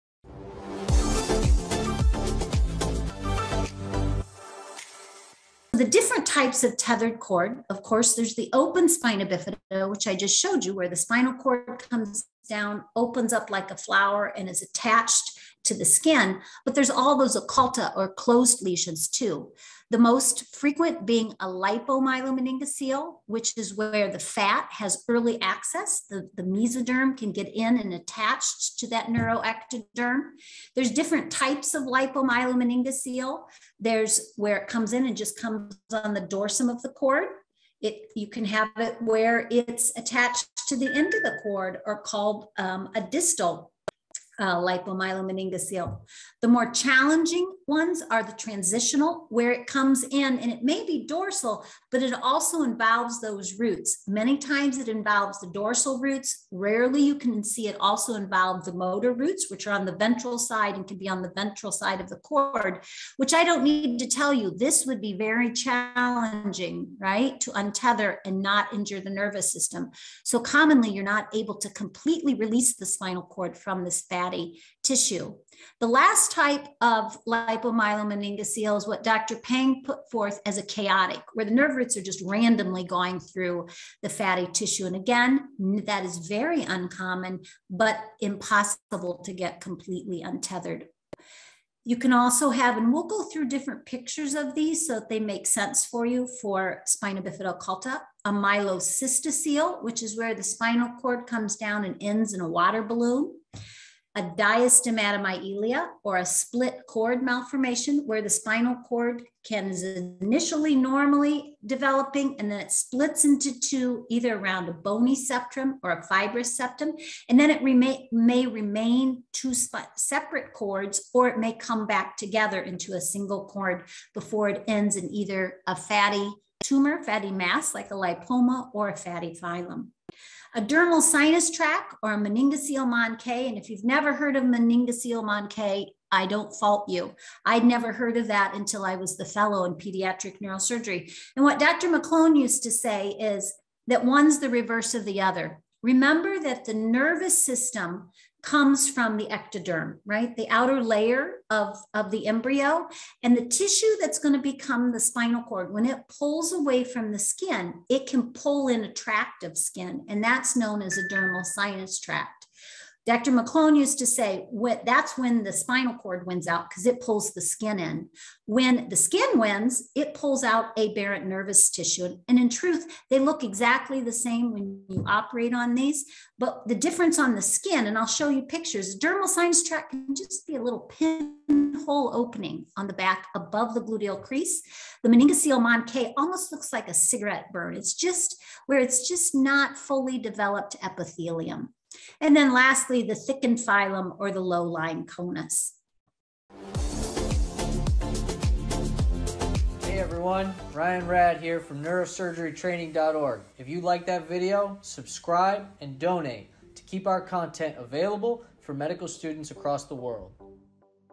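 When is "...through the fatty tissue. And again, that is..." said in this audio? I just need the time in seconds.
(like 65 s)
83 s.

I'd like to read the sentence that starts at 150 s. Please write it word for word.
The outer layer of, of the embryo.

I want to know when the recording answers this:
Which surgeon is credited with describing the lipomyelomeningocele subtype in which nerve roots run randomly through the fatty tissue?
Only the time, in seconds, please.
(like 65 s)
79 s.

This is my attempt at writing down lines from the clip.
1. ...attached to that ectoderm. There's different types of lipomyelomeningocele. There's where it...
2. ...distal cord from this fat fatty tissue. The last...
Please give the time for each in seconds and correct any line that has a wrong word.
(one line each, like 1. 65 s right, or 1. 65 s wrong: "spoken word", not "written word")
1. 27 s wrong: "neuroectoderm", not "ectoderm"
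2. 72 s wrong: "spinal", not "distal".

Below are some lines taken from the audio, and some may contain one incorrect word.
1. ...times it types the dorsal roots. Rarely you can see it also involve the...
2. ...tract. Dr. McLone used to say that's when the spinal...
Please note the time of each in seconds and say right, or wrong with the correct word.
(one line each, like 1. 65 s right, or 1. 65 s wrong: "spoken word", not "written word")
1. 54 s wrong: "involves", not "types"
2. 161 s right.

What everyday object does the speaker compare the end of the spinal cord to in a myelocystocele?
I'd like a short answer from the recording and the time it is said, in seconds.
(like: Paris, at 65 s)
a water balloon, at 102 s.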